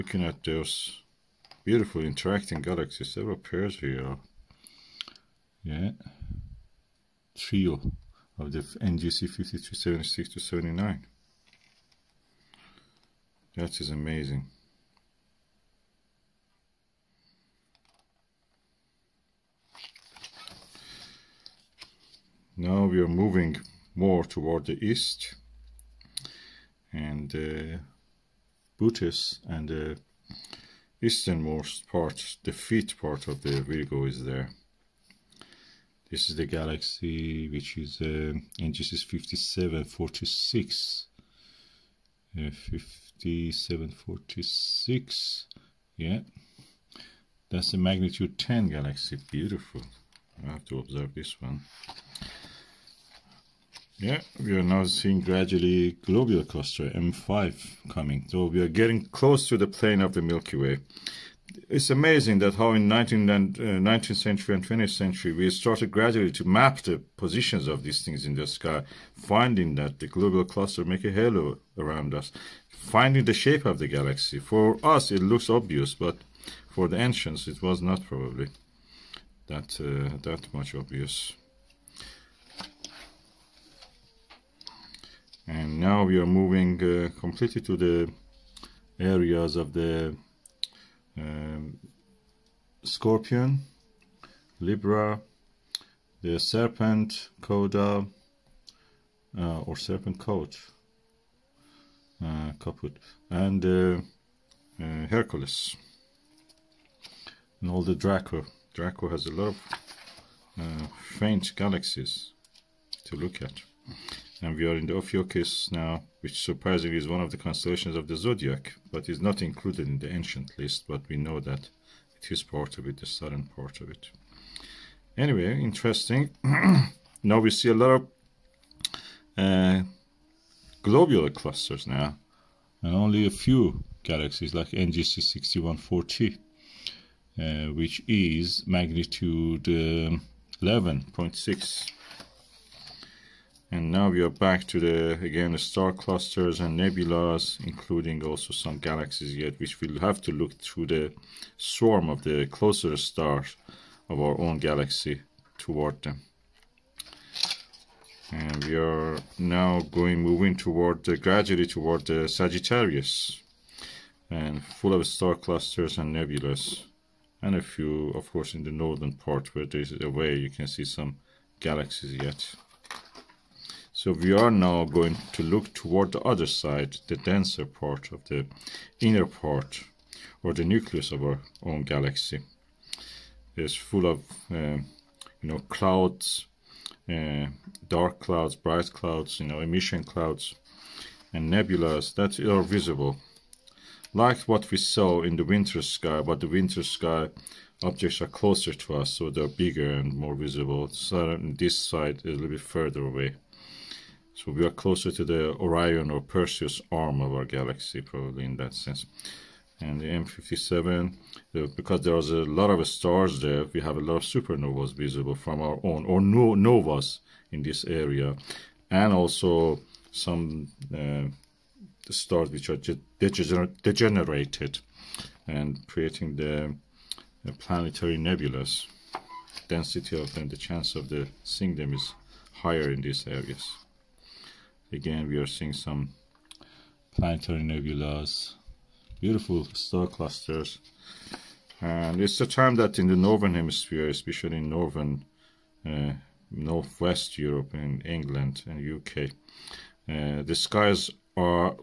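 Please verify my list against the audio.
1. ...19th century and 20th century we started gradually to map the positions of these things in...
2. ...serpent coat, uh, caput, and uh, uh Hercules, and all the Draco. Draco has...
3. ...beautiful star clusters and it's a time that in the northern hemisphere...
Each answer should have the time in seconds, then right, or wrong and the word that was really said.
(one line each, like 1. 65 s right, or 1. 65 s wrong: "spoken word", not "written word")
1. 63 s right
2. 99 s right
3. 239 s right.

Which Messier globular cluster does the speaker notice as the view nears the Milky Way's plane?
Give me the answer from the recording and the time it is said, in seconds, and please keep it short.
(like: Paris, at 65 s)
M5, at 56 s.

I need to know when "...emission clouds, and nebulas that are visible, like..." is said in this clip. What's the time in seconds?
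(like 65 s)
189 s.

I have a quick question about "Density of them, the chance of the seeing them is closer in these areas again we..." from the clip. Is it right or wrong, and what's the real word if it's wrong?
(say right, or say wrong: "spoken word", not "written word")
wrong: "higher", not "closer".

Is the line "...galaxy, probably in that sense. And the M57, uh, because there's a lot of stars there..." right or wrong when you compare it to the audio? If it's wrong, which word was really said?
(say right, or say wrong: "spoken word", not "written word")
right.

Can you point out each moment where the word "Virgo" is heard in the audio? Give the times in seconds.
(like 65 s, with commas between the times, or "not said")
33 s.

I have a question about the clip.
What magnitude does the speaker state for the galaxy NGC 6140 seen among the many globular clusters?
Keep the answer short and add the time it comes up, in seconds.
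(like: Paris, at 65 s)
11.6, at 140 s.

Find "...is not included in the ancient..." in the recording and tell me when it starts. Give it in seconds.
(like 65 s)
119 s.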